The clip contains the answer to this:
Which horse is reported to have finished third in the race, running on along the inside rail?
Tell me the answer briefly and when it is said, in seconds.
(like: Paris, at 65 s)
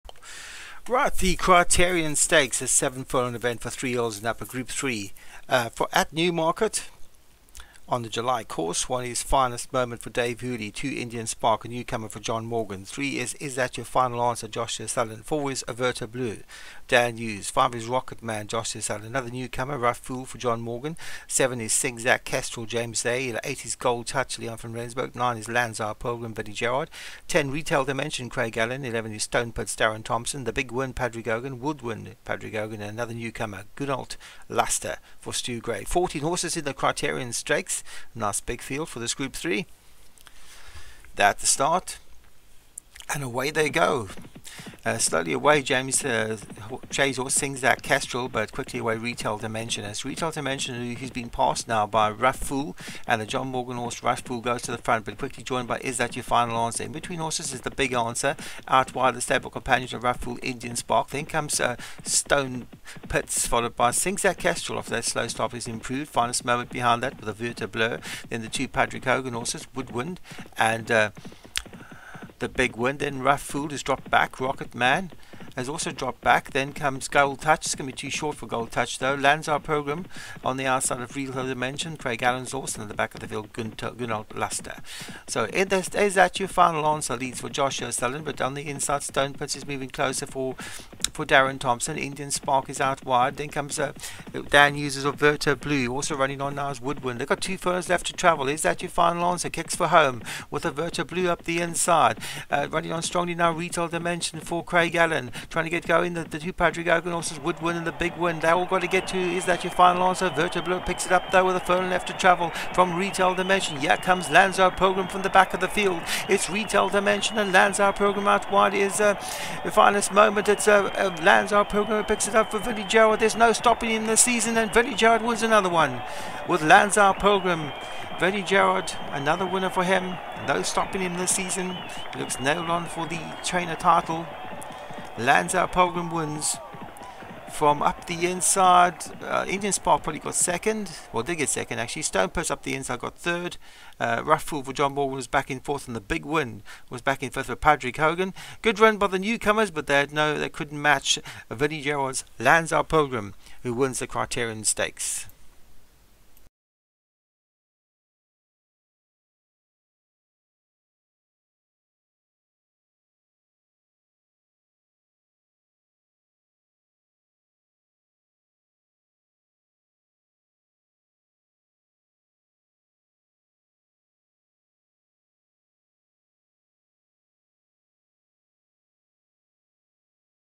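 Stonepud, at 142 s.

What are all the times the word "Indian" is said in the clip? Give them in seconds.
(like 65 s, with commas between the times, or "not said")
10 s, 60 s, 91 s, 139 s.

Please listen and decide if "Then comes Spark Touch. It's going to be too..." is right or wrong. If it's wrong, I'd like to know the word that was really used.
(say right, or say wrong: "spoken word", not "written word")
wrong: "Gold", not "Spark".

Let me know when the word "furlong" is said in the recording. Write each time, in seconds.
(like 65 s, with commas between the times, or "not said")
3 s, 97 s, 111 s.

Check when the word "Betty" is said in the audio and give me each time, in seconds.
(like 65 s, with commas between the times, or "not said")
26 s.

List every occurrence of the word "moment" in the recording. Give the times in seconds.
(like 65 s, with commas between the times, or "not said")
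9 s, 66 s, 120 s.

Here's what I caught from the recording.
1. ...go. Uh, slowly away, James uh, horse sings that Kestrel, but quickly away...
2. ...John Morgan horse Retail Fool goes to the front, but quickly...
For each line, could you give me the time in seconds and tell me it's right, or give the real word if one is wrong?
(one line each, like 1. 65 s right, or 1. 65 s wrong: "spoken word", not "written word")
1. 43 s right
2. 53 s wrong: "Rough", not "Retail".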